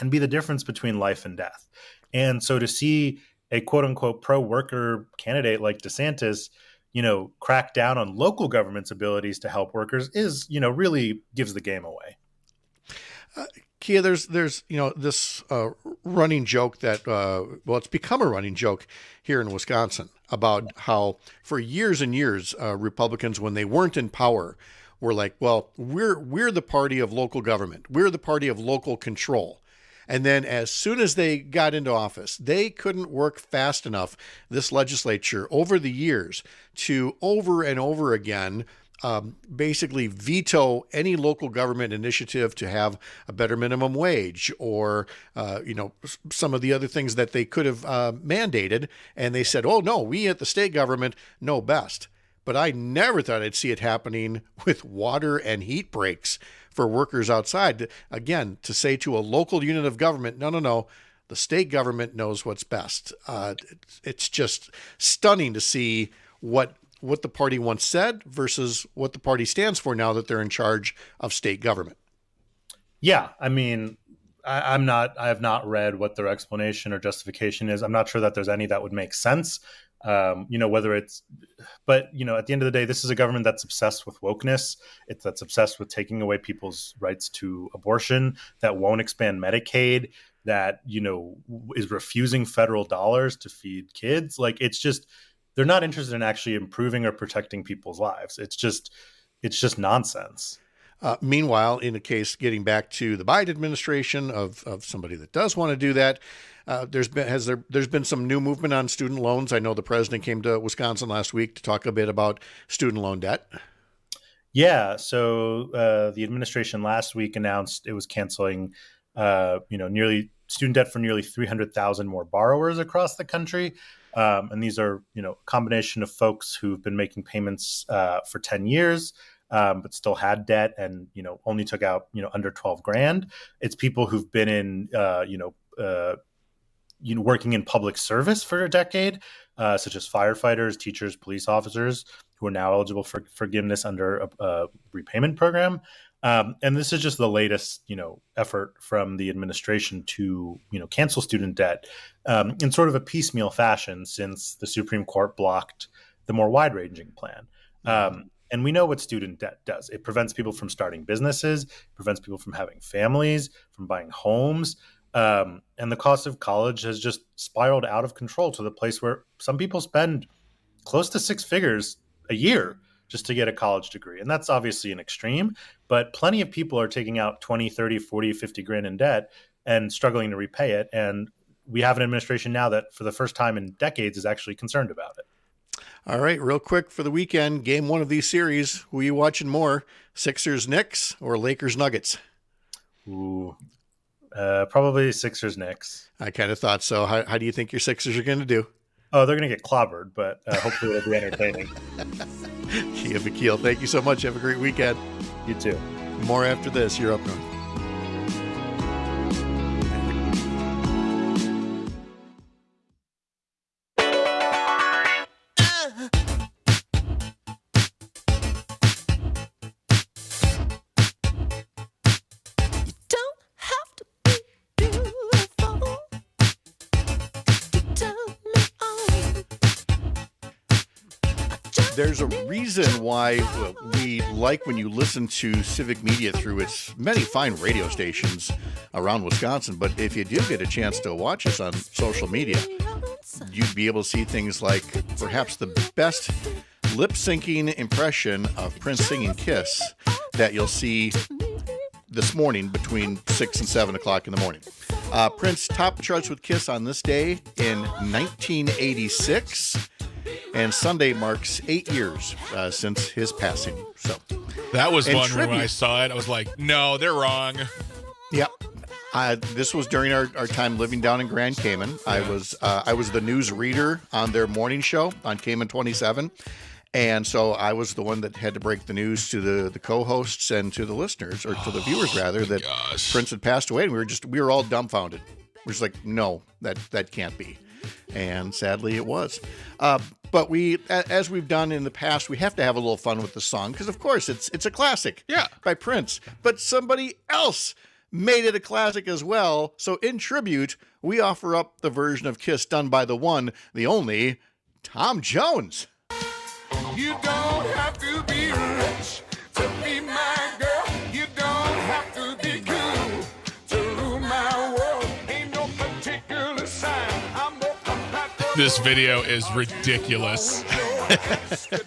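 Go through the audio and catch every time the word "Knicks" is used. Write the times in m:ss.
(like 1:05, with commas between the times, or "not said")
3:10, 3:15.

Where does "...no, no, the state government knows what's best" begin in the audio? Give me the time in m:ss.
1:00.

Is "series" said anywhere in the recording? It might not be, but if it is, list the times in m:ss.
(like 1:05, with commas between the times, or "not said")
3:08.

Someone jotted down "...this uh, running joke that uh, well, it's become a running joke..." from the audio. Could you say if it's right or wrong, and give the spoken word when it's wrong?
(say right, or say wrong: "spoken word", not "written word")
right.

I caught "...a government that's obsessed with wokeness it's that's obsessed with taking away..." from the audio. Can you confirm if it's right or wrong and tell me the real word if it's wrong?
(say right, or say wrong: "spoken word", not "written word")
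right.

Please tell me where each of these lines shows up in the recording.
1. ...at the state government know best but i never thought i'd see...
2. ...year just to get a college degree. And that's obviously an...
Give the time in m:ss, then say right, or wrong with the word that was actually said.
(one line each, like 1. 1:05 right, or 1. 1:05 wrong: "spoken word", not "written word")
1. 0:50 right
2. 2:52 right.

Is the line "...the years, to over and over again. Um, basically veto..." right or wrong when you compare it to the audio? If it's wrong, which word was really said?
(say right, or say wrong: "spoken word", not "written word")
right.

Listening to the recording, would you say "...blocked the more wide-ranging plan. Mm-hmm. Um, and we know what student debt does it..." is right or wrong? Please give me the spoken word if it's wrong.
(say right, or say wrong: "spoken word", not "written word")
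right.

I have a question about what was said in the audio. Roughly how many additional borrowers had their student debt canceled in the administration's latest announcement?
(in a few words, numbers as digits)
300,000.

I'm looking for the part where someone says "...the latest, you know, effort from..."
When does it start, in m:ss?
2:27.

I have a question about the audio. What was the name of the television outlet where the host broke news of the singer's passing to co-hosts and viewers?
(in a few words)
Cayman 27.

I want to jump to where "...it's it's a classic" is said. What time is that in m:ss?
4:54.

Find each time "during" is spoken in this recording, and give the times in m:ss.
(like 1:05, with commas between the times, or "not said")
4:29.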